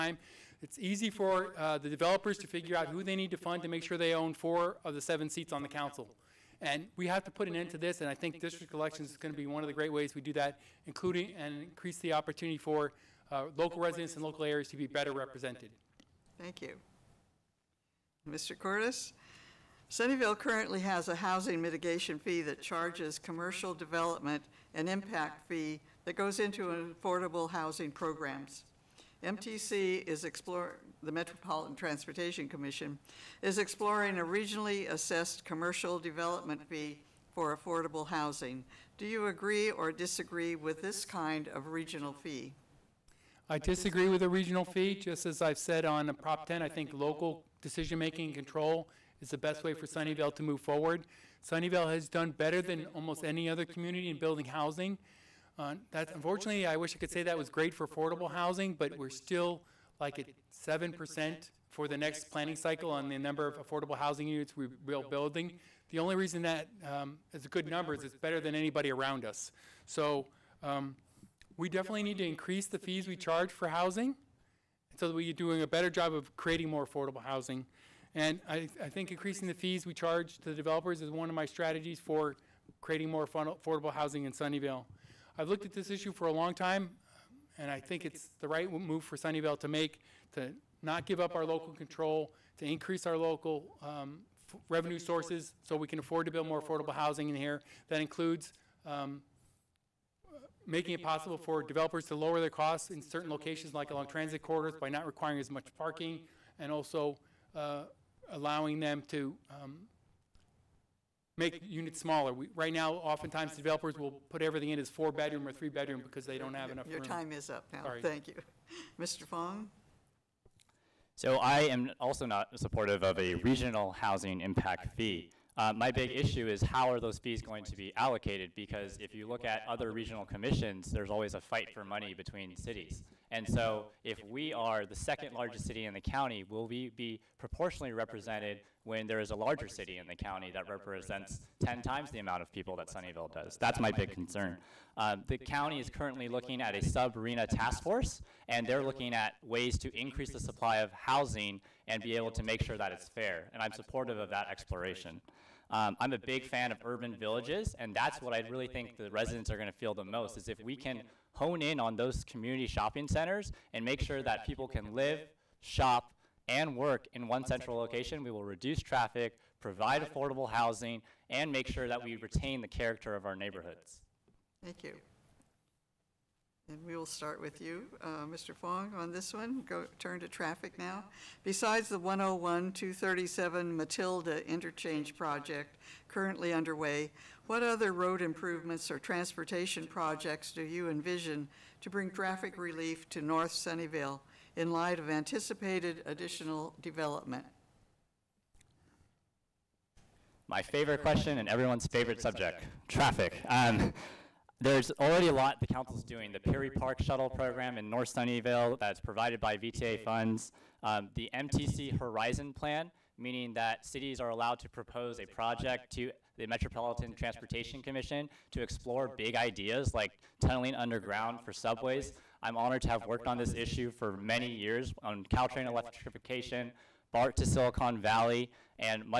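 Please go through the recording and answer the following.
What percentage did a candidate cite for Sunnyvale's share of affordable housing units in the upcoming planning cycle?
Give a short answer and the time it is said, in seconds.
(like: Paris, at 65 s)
7%, at 60 s.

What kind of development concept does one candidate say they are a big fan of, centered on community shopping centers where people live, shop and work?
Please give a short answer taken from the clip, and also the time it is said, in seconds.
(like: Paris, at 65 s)
Urban villages, at 156 s.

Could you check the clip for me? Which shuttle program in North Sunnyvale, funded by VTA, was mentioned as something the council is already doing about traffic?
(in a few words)
Peery Park Shuttle Program.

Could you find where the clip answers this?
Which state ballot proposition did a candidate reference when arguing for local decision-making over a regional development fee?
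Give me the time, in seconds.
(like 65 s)
46 s.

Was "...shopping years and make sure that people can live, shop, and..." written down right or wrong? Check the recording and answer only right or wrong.
wrong.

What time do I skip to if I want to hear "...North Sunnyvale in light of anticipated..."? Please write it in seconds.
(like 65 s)
193 s.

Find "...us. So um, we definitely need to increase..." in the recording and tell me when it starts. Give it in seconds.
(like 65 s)
69 s.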